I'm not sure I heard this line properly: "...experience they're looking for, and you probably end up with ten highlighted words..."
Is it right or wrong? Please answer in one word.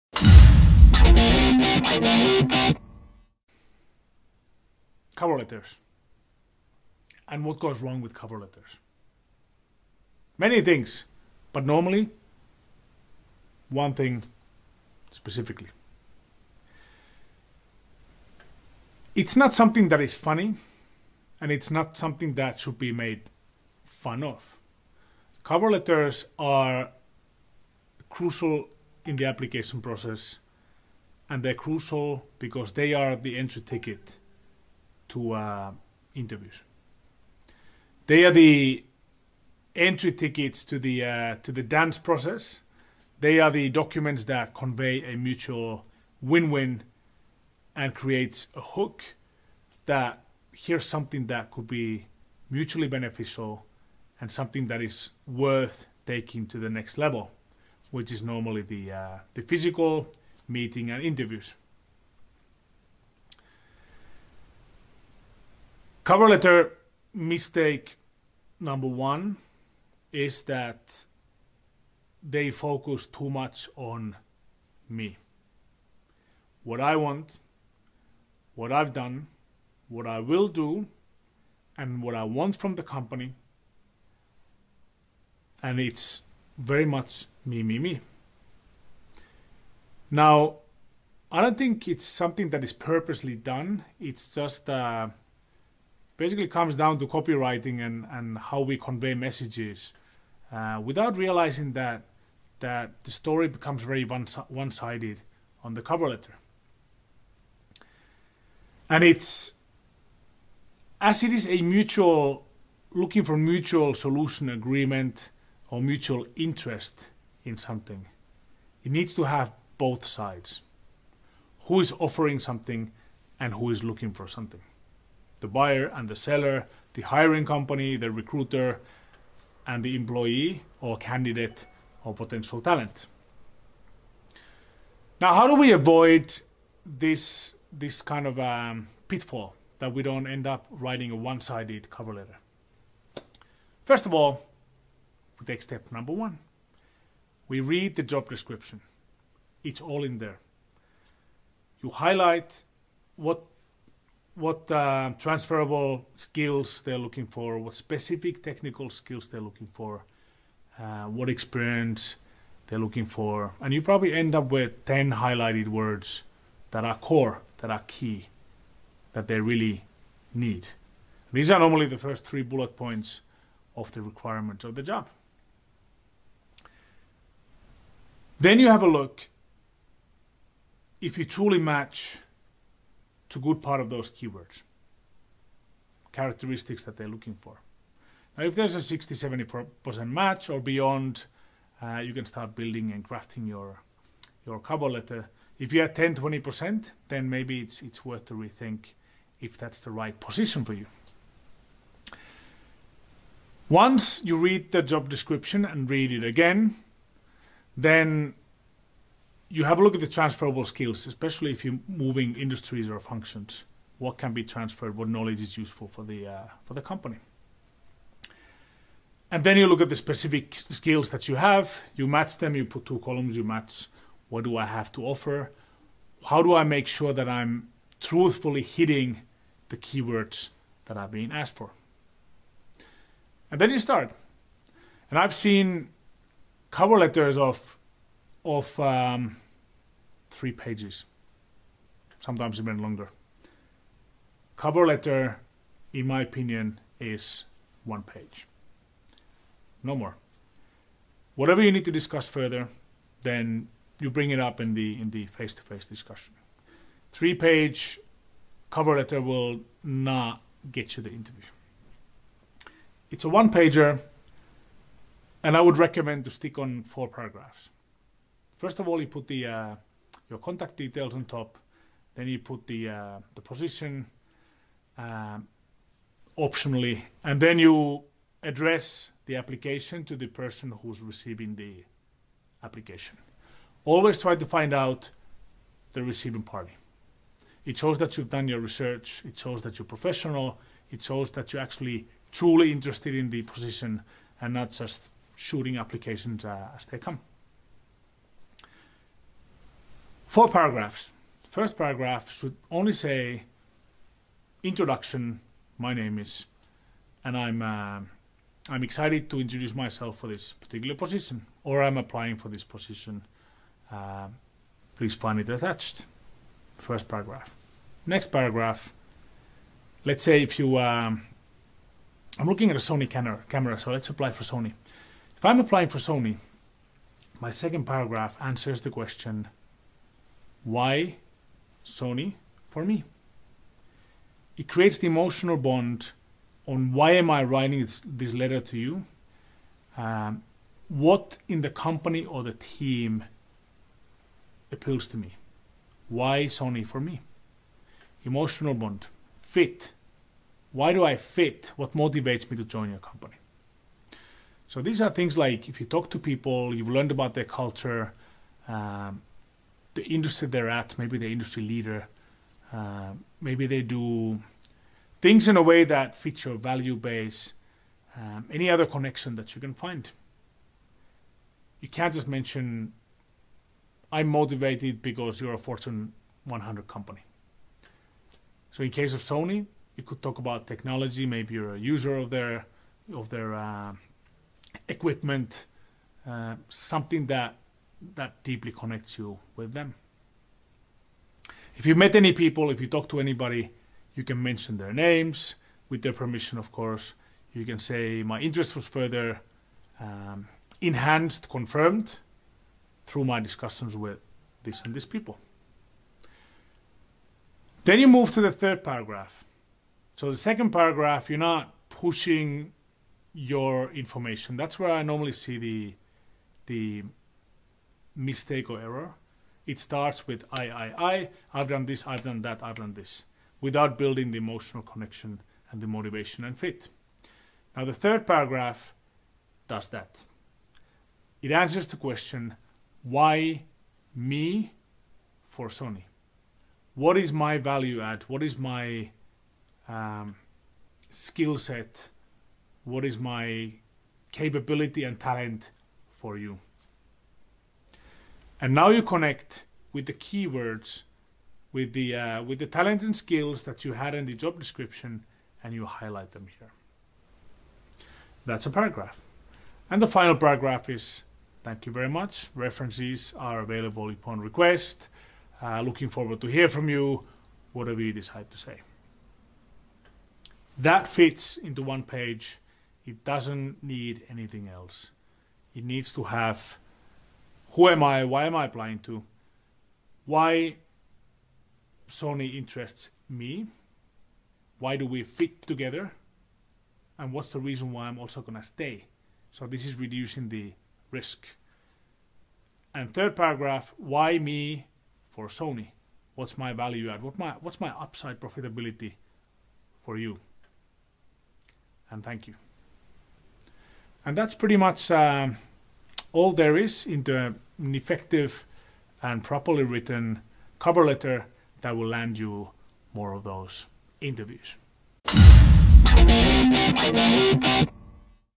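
right.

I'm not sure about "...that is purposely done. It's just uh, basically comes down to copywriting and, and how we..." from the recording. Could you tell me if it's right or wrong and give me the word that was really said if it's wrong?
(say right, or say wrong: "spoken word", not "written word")
right.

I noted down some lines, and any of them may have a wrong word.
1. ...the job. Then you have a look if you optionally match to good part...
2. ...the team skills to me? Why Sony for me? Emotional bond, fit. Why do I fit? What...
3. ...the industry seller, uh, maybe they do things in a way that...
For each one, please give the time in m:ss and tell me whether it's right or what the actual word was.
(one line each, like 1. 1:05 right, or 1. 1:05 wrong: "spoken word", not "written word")
1. 2:54 wrong: "truly", not "optionally"
2. 5:42 wrong: "appeals", not "skills"
3. 6:01 wrong: "leader", not "seller".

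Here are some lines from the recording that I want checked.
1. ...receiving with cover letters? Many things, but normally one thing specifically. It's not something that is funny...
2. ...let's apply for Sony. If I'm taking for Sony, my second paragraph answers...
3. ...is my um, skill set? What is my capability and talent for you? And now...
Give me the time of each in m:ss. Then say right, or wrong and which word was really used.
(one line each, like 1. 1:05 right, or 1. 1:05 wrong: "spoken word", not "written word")
1. 0:07 wrong: "wrong", not "receiving"
2. 5:23 wrong: "applying", not "taking"
3. 7:18 right.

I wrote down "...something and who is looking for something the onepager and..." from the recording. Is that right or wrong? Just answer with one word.
wrong.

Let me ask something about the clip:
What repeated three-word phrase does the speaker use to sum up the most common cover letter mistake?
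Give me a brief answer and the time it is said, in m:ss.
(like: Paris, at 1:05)
me, me, me, at 1:27.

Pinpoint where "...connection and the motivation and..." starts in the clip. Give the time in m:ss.
7:04.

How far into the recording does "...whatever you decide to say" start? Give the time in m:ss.
7:47.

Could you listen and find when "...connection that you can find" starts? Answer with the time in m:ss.
6:08.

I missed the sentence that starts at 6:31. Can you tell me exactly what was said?
If you met any people, if you talk to anybody, you can mention their names with their permission, of course.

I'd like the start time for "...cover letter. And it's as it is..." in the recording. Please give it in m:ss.
1:45.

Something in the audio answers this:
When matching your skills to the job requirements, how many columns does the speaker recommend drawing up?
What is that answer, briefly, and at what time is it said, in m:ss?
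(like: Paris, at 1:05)
2, at 3:42.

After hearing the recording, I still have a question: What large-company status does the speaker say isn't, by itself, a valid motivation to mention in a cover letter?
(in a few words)
Fortune 100.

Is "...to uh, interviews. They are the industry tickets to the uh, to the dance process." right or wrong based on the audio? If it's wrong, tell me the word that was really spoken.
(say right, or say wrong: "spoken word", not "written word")
wrong: "entry", not "industry".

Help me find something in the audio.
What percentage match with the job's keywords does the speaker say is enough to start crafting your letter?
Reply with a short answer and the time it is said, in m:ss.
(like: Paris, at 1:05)
60-70%, at 3:08.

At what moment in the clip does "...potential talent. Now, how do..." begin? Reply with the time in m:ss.
2:12.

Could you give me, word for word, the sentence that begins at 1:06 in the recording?
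Cover letter mistake number one is that they focus too much on me.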